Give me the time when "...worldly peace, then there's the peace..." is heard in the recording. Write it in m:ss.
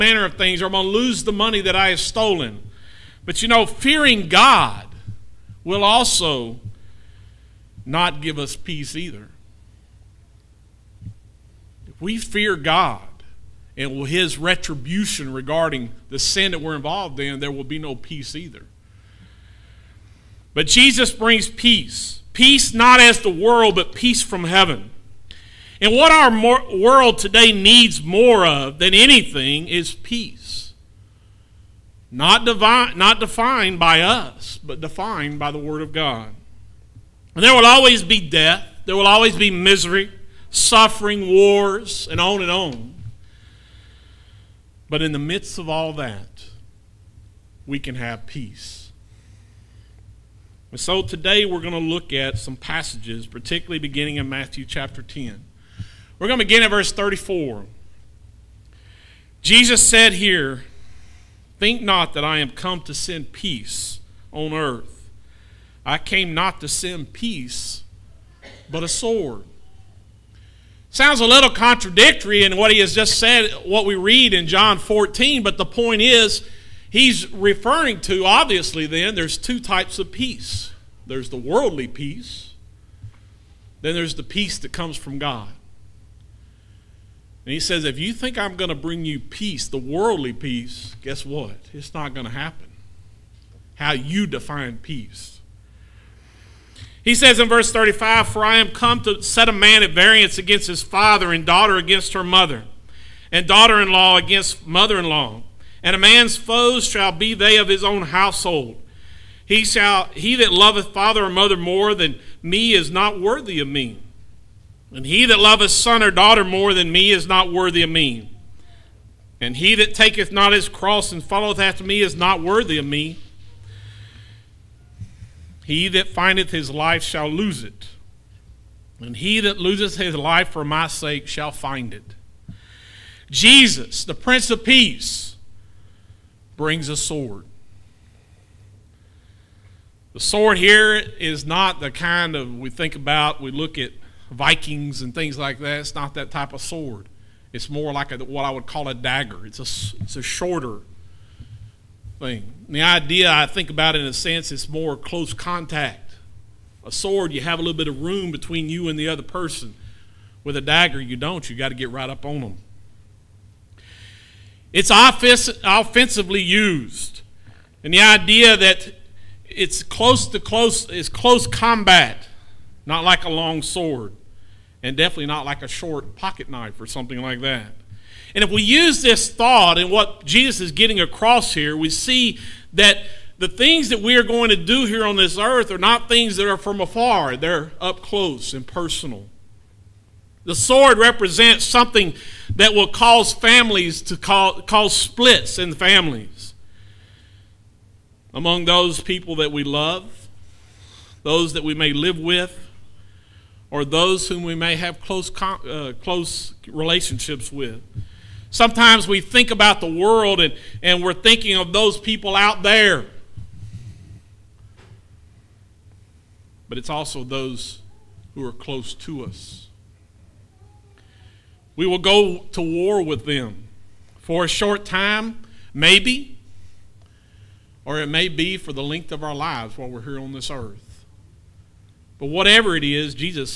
1:21.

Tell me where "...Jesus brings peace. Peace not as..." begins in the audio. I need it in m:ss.
0:20.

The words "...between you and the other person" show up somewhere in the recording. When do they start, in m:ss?
2:38.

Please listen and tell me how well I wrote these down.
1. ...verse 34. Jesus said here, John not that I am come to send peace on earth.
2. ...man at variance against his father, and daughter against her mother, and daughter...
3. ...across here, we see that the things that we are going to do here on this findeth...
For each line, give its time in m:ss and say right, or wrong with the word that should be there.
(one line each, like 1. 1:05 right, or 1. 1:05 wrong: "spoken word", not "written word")
1. 0:56 wrong: "Think", not "John"
2. 1:39 right
3. 3:00 wrong: "earth", not "findeth".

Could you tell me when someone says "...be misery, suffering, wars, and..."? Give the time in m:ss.
0:39.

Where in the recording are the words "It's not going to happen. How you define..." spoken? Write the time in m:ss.
1:31.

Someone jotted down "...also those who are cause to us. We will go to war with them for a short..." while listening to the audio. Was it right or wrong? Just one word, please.
wrong.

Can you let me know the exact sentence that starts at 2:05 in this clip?
He that findeth his life shall lose it, and he that loseth his life for my sake shall find it.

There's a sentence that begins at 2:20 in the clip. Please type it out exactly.
The sword here is not the kind of we think about, we look at Vikings and things like that.